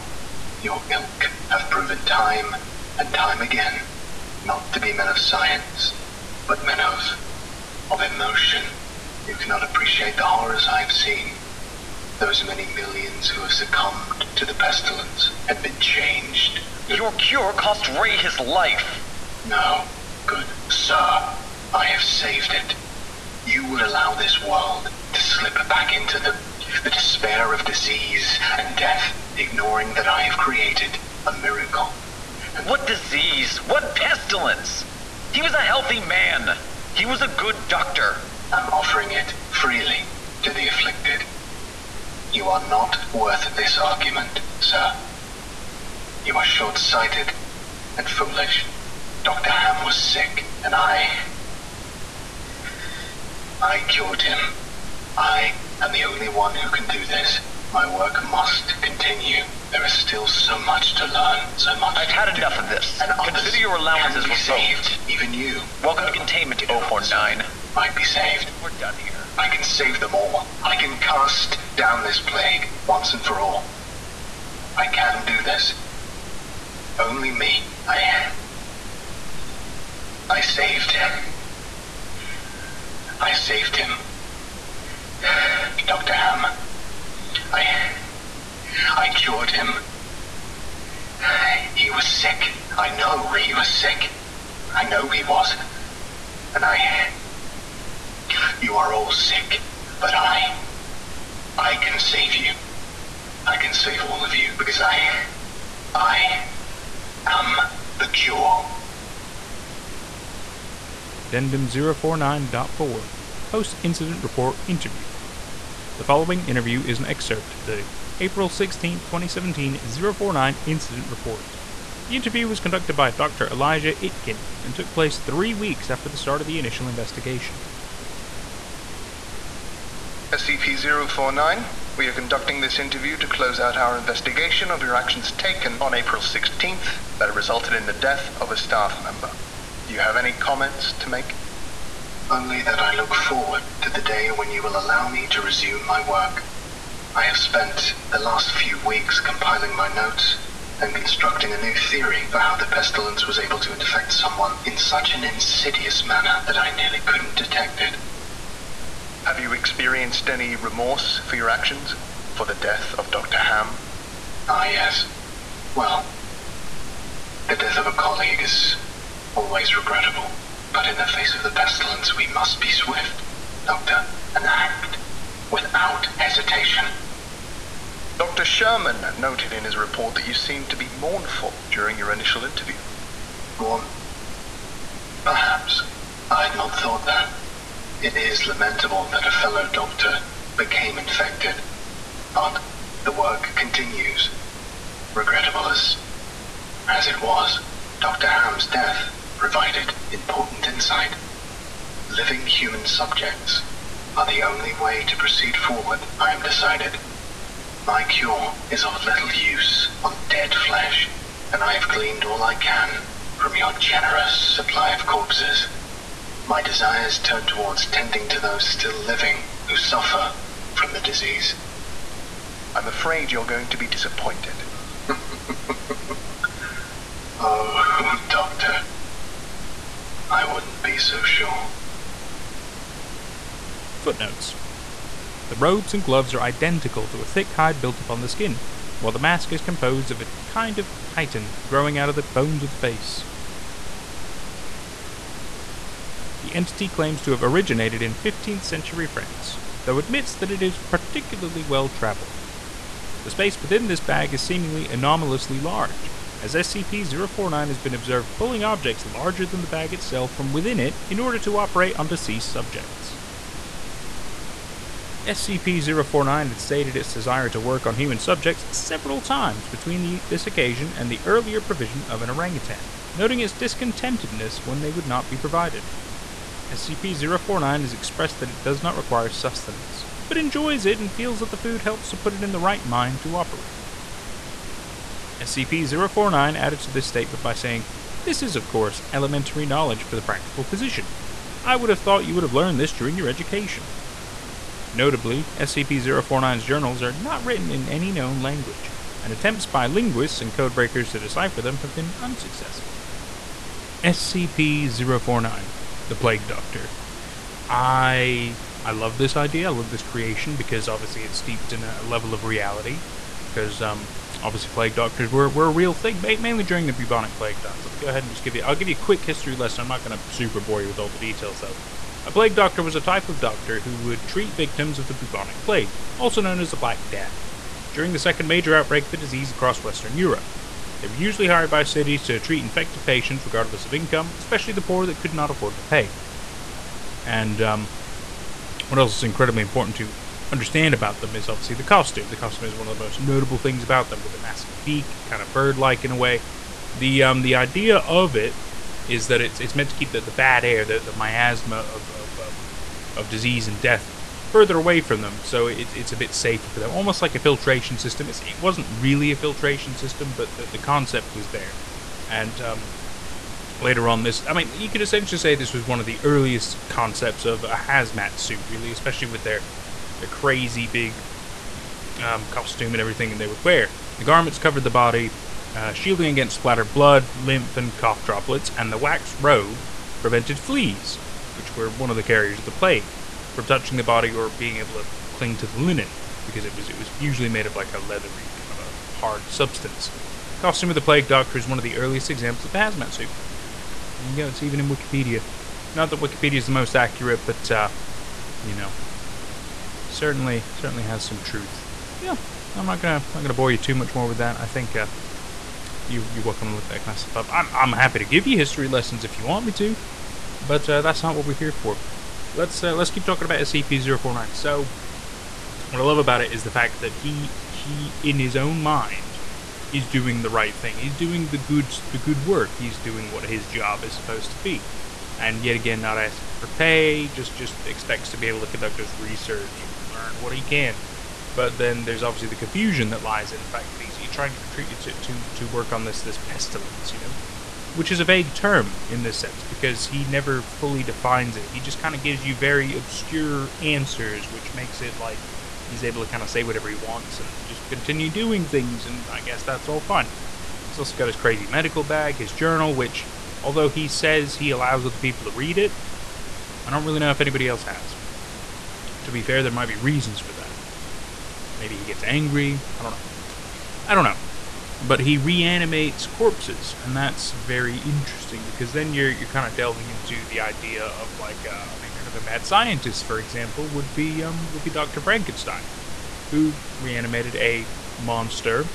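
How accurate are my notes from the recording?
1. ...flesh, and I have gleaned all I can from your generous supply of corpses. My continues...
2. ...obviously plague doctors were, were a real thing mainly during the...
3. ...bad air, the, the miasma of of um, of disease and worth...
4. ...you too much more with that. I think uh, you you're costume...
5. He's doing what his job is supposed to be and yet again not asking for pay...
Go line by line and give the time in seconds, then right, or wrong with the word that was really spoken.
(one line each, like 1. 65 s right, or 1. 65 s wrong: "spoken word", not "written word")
1. 210 s wrong: "desires", not "continues"
2. 314 s right
3. 350 s wrong: "death", not "worth"
4. 403 s wrong: "welcome", not "costume"
5. 422 s right.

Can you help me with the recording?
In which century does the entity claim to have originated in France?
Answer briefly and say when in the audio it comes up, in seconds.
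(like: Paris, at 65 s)
15th century, at 248 s.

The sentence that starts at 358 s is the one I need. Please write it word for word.
It's, it wasn't really a filtration system, but the, the concept was there.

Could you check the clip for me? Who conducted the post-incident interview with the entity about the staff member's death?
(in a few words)
Dr. Elijah Itkin.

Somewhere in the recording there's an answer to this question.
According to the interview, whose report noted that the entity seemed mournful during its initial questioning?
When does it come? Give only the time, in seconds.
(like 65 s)
178 s.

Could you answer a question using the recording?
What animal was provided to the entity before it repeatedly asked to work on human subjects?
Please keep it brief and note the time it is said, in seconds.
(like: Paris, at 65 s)
orangutan, at 272 s.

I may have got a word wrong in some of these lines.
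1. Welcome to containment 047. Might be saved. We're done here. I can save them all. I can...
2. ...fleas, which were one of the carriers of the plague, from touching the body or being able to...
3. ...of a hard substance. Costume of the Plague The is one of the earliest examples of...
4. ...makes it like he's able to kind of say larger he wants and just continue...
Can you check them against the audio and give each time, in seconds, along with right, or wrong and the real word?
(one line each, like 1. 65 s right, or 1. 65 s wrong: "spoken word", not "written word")
1. 65 s wrong: "049", not "047"
2. 380 s right
3. 388 s wrong: "Doctor", not "The"
4. 444 s wrong: "whatever", not "larger".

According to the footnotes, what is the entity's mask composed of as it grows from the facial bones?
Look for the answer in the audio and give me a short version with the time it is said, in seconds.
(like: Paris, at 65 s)
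chitin, at 241 s.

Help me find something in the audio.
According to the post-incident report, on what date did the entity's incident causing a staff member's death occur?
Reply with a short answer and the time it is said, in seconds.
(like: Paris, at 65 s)
April 16, 2017, at 118 s.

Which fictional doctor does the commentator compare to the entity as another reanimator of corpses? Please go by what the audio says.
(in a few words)
Doctor Frankenstein.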